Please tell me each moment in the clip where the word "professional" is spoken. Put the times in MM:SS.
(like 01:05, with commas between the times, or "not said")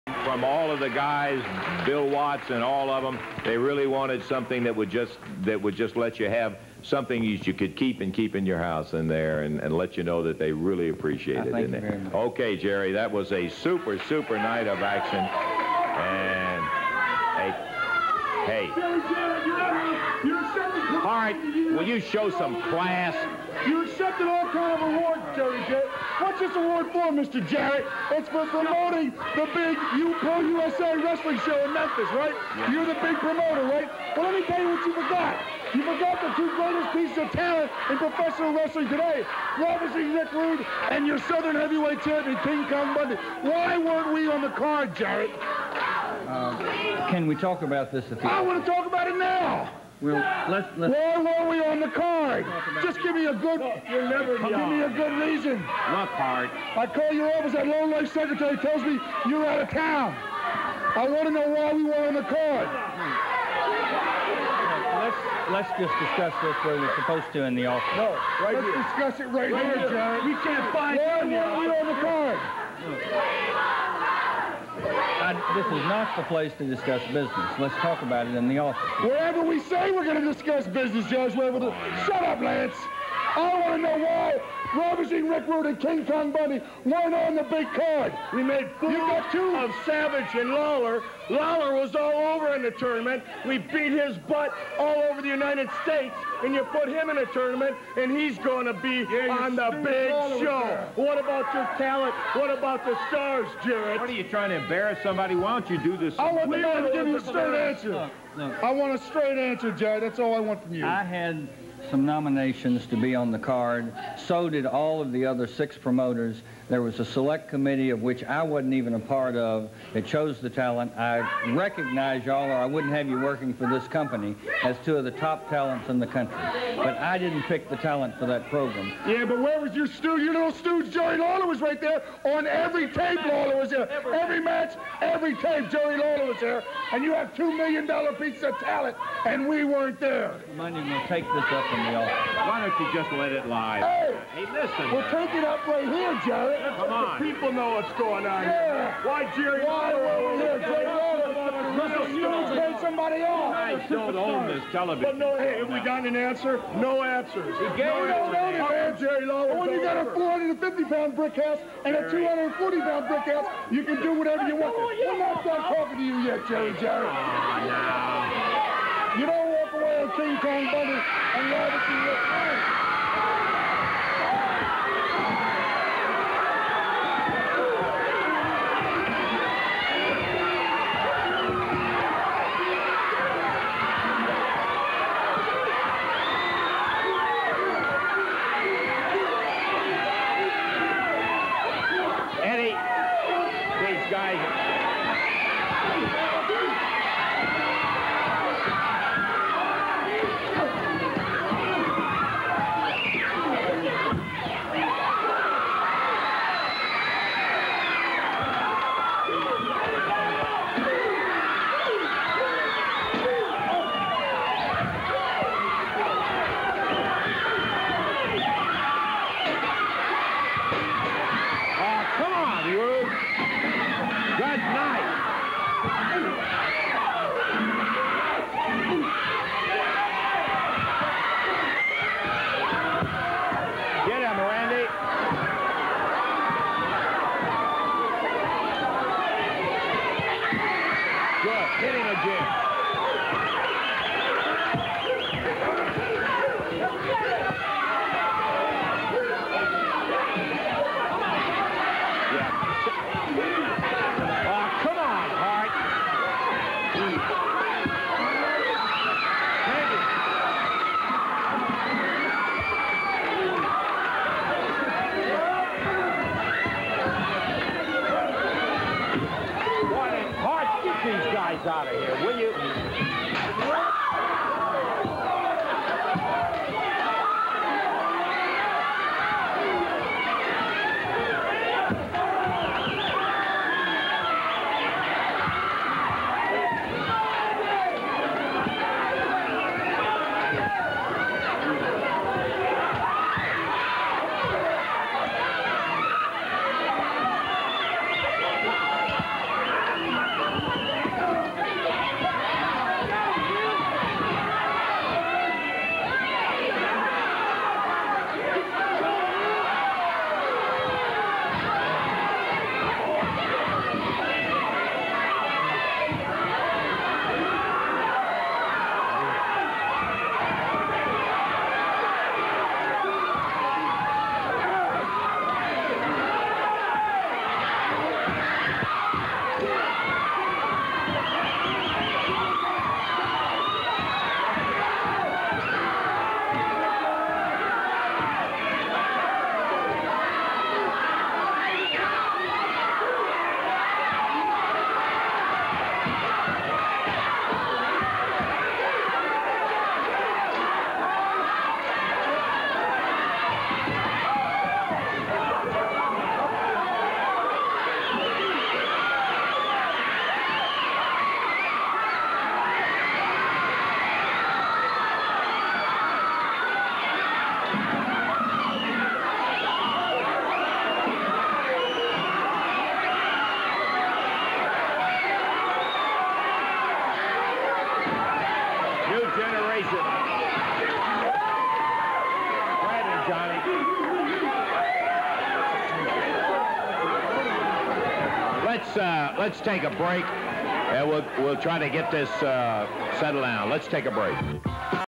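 00:37.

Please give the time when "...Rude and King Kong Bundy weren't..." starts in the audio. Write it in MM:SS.
01:25.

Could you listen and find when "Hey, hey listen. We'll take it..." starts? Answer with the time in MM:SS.
02:23.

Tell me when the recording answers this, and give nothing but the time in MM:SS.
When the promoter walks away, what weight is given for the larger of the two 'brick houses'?
02:40.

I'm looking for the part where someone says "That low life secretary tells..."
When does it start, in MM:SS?
00:57.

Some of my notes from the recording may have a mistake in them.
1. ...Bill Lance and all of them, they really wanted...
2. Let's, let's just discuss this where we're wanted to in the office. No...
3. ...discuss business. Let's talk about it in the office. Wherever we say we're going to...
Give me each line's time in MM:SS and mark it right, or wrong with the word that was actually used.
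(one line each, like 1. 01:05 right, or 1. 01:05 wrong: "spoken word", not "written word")
1. 00:01 wrong: "Watts", not "Lance"
2. 01:05 wrong: "supposed", not "wanted"
3. 01:16 right.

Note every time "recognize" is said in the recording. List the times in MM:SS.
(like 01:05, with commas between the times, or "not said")
02:01.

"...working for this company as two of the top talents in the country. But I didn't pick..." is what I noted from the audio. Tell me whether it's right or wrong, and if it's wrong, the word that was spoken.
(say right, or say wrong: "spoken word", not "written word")
right.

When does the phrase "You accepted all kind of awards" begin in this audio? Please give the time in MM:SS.
00:23.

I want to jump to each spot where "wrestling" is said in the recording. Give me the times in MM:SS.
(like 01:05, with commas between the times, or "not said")
00:30, 00:38.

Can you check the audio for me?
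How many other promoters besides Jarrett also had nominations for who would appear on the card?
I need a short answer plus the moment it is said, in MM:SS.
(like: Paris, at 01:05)
6, at 01:55.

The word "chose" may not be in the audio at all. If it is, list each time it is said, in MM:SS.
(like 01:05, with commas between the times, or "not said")
02:00.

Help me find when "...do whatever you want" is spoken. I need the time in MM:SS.
02:44.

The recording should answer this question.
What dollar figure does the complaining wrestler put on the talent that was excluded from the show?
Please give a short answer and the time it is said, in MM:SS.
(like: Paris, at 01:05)
$2 million, at 02:17.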